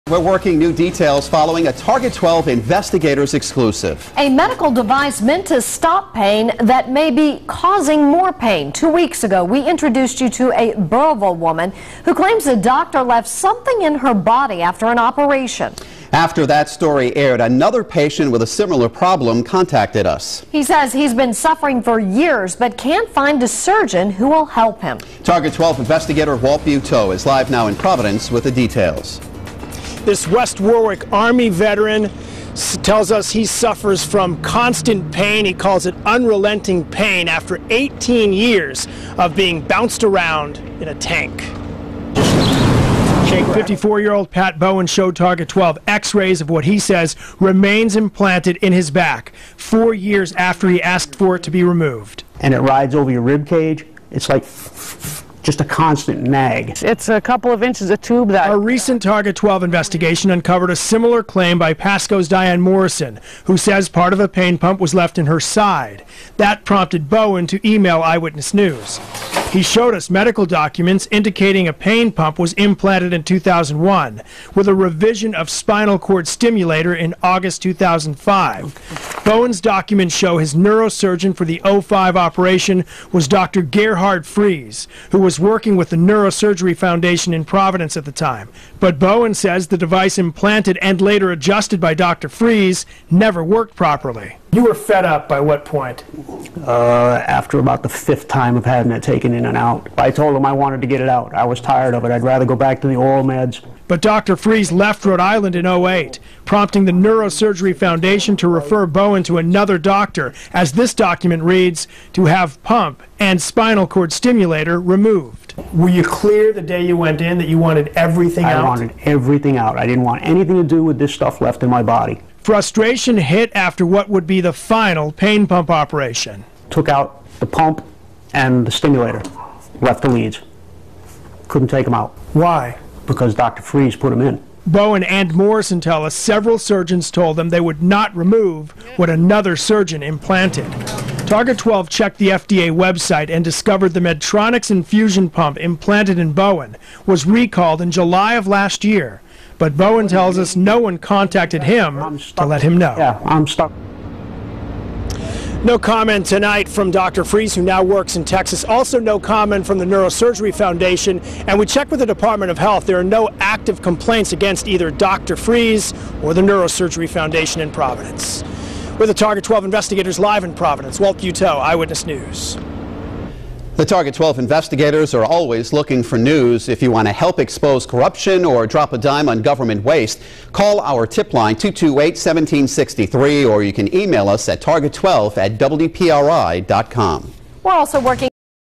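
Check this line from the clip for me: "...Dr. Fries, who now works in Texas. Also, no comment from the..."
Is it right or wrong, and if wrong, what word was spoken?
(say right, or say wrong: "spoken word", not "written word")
right.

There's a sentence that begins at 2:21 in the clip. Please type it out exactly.
Target 12 checked the FDA website and discovered the Medtronic's infusion pump implanted in Bowen was recalled in July of last year.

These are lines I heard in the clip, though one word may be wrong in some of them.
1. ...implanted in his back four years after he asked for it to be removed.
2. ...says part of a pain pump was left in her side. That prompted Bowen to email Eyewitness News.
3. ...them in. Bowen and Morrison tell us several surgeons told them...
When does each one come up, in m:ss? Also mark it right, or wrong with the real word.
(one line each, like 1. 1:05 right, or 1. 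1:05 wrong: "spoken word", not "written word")
1. 0:47 right
2. 1:03 right
3. 2:14 right.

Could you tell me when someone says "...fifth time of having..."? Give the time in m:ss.
1:37.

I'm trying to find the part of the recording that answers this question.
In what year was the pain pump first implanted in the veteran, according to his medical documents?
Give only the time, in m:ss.
1:13.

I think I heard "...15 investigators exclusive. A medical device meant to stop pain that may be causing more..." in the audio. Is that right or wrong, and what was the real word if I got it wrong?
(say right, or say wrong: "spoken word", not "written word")
wrong: "12", not "15".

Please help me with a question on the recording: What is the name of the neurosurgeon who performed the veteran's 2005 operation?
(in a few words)
Dr. Gerhard Fries.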